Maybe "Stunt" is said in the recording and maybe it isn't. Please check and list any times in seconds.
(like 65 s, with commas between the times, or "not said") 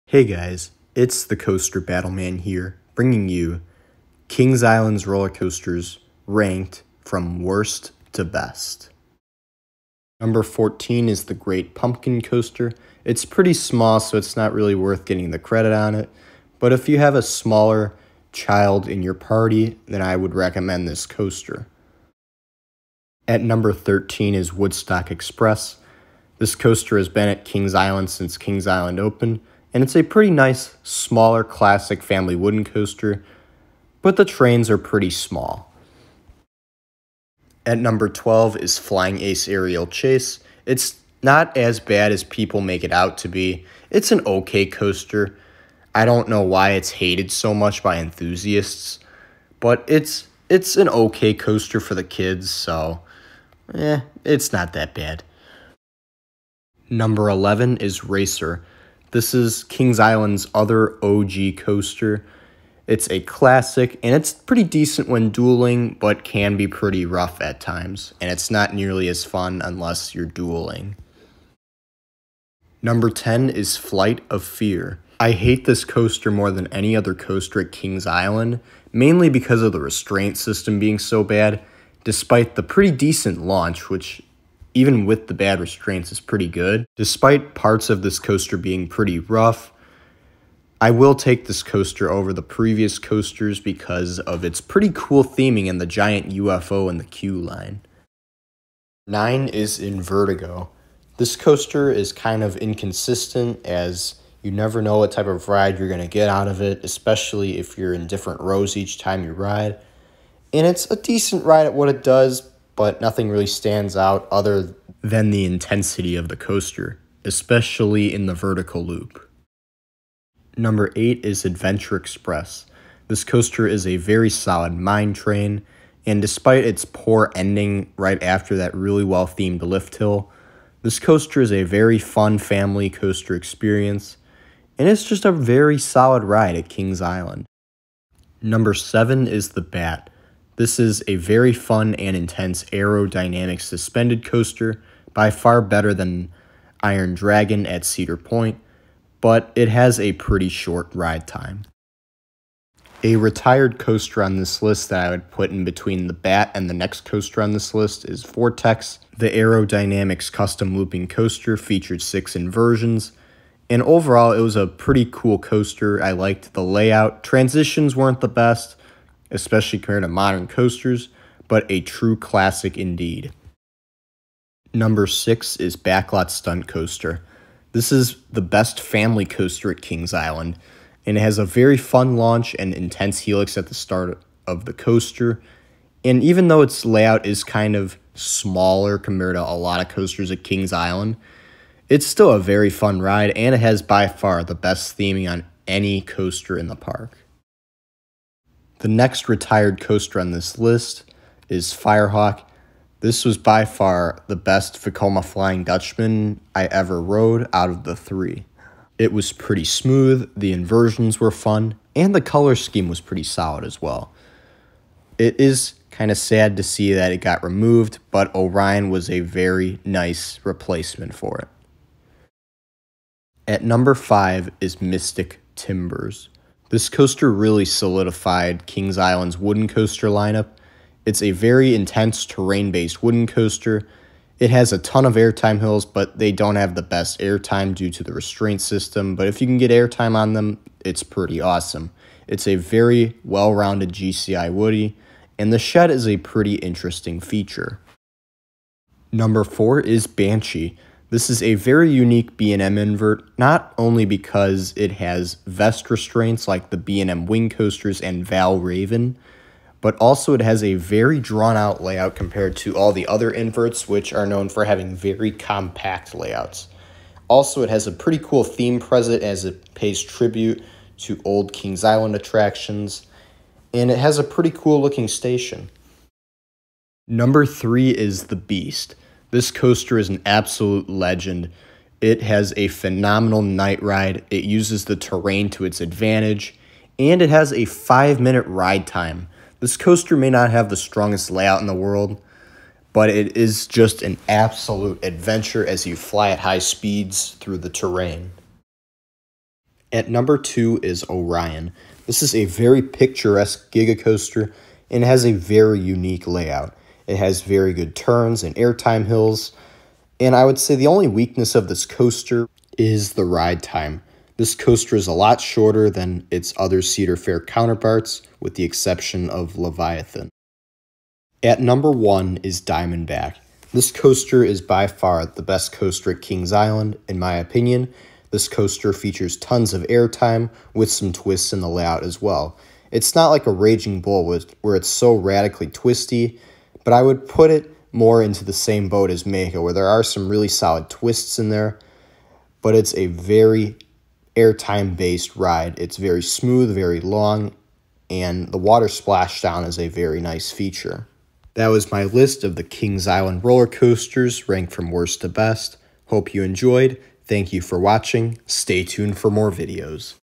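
176 s.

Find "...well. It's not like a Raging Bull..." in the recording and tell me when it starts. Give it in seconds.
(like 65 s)
332 s.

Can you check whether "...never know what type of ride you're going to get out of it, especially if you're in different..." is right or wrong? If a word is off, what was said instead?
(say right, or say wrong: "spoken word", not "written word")
right.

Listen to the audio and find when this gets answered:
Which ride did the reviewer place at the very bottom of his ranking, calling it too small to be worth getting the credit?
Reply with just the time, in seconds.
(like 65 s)
11 s.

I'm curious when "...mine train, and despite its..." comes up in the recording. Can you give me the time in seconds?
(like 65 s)
124 s.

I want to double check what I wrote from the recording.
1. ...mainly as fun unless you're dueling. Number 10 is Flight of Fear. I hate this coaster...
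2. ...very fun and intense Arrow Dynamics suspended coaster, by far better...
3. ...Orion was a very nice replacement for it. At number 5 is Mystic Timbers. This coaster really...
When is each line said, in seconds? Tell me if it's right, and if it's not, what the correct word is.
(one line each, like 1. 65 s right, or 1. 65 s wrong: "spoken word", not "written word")
1. 68 s wrong: "nearly", not "mainly"
2. 141 s right
3. 218 s right.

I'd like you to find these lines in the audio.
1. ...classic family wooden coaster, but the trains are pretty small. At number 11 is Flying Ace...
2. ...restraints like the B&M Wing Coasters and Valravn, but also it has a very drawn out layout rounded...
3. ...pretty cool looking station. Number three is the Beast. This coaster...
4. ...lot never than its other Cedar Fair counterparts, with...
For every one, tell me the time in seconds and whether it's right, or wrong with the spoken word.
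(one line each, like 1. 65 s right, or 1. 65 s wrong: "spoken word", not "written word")
1. 31 s wrong: "12", not "11"
2. 255 s wrong: "compared", not "rounded"
3. 274 s right
4. 315 s wrong: "shorter", not "never".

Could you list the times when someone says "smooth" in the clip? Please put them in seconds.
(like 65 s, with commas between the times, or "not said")
209 s, 346 s.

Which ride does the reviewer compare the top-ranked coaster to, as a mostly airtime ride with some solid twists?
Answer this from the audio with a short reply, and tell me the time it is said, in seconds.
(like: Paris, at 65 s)
Mako, at 339 s.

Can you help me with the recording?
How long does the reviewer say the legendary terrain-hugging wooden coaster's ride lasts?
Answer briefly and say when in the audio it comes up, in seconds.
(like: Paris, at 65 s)
5 minutes, at 287 s.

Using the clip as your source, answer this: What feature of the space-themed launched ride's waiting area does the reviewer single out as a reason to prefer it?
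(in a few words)
giant UFO.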